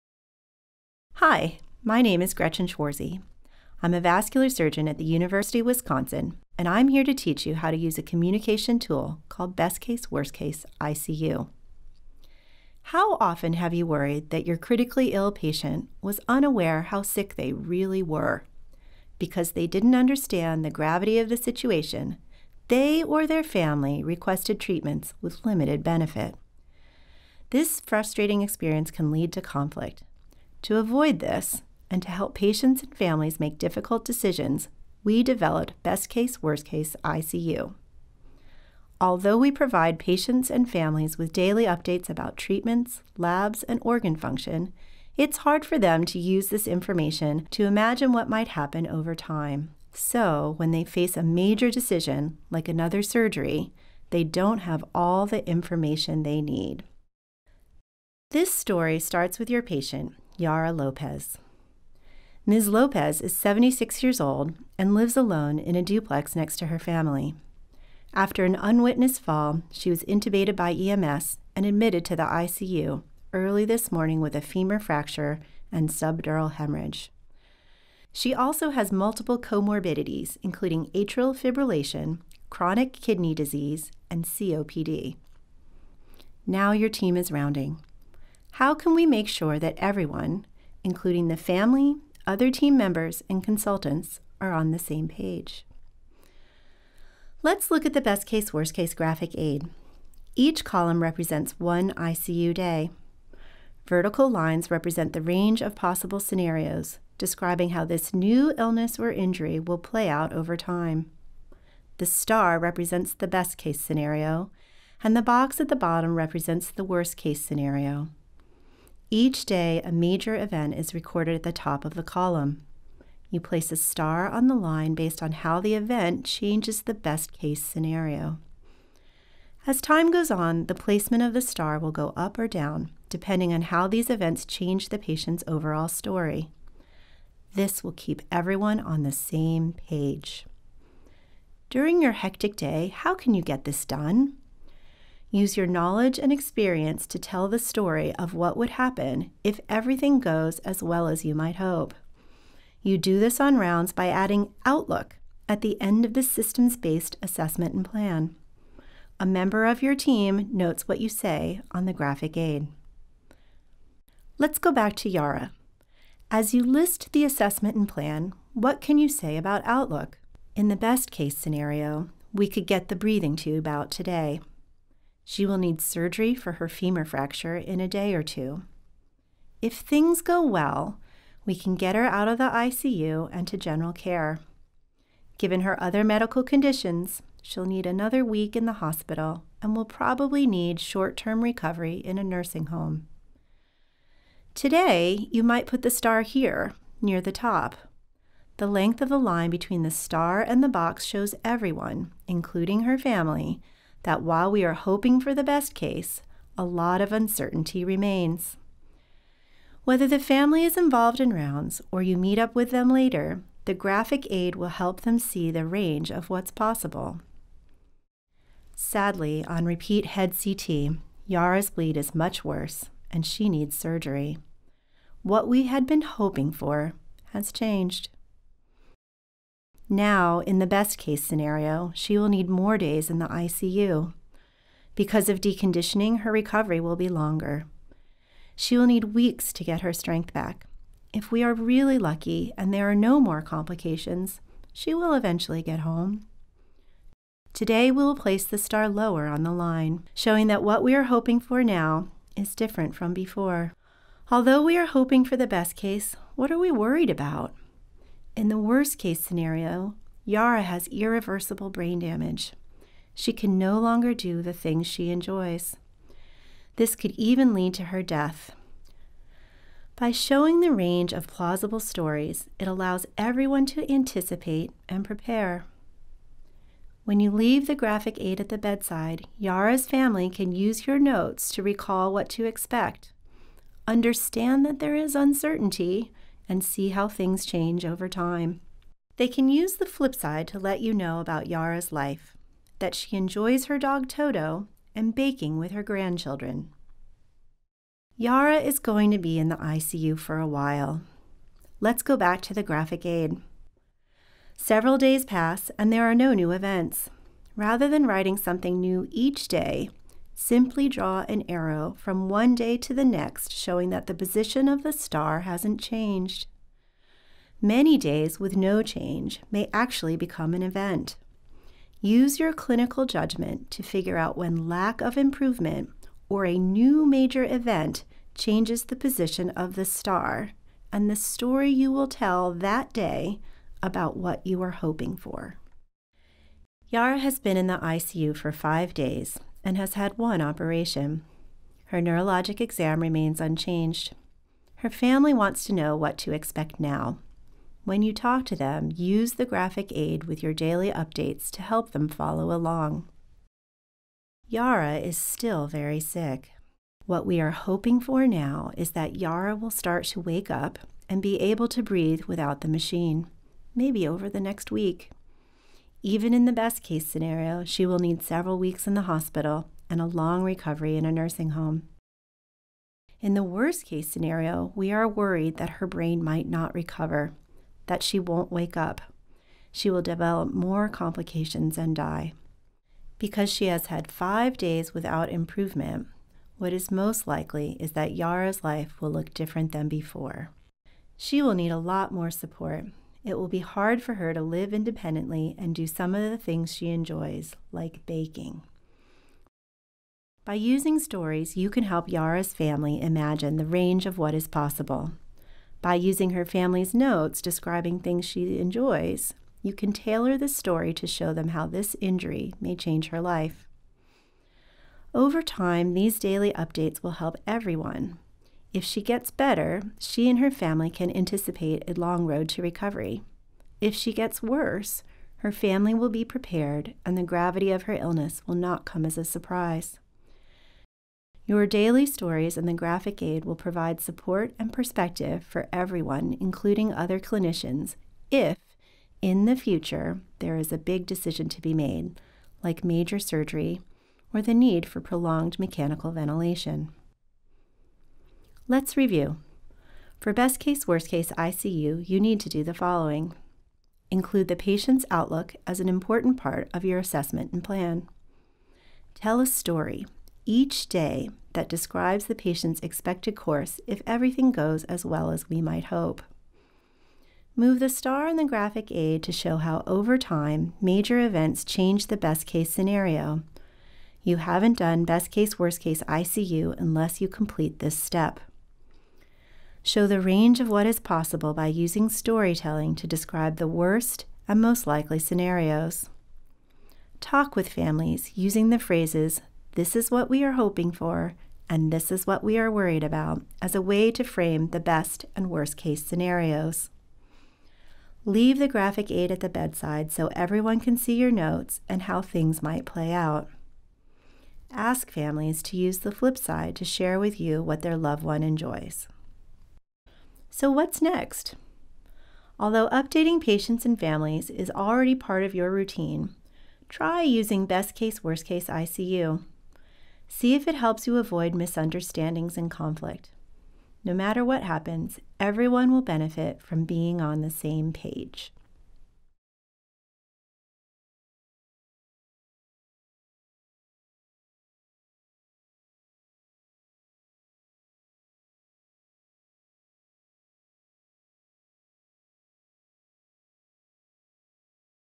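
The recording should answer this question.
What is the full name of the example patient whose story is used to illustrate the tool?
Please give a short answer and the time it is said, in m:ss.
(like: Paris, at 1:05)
Yara Lopez, at 1:00.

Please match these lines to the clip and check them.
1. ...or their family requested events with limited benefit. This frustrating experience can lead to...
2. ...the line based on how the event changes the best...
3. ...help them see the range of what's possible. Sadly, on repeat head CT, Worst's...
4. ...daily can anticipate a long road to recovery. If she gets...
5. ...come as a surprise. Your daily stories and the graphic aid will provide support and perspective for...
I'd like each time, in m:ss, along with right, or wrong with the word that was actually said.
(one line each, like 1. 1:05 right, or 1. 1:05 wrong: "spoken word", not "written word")
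1. 0:23 wrong: "treatments", not "events"
2. 2:04 right
3. 3:34 wrong: "Yara", not "Worst"
4. 7:00 wrong: "family", not "daily"
5. 7:08 right.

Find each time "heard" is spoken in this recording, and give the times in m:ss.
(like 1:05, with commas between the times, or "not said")
not said.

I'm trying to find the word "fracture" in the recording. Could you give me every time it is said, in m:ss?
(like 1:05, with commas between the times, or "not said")
1:14, 2:57.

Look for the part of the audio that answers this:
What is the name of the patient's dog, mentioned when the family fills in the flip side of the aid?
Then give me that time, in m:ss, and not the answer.
4:54.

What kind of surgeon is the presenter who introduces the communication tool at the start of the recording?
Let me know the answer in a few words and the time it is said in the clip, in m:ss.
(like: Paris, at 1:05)
vascular surgeon, at 0:04.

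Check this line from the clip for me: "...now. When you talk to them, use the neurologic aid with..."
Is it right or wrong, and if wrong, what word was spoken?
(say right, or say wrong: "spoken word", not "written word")
wrong: "graphic", not "neurologic".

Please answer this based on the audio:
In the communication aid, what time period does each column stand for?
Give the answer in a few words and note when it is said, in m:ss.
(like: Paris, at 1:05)
one ICU day, at 1:41.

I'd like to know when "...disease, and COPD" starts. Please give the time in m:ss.
1:23.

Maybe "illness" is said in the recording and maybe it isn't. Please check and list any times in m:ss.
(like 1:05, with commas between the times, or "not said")
1:48, 7:07.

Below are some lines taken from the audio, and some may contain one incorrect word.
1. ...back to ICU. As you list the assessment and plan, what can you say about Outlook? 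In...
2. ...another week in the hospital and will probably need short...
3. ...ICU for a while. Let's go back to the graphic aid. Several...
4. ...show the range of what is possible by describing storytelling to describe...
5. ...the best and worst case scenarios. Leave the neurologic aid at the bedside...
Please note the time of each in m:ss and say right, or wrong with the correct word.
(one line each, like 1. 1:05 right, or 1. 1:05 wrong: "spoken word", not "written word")
1. 2:44 wrong: "Yara", not "ICU"
2. 3:07 right
3. 4:59 right
4. 7:59 wrong: "using", not "describing"
5. 8:14 wrong: "graphic", not "neurologic".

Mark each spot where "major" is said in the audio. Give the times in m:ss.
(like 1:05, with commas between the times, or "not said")
0:51, 1:59, 5:27, 7:22, 7:50.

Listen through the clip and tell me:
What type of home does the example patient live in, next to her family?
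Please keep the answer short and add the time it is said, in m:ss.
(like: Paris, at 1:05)
a duplex, at 1:05.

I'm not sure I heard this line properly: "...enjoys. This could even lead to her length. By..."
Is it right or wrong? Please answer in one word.
wrong.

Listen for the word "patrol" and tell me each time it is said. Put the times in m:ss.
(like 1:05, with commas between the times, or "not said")
not said.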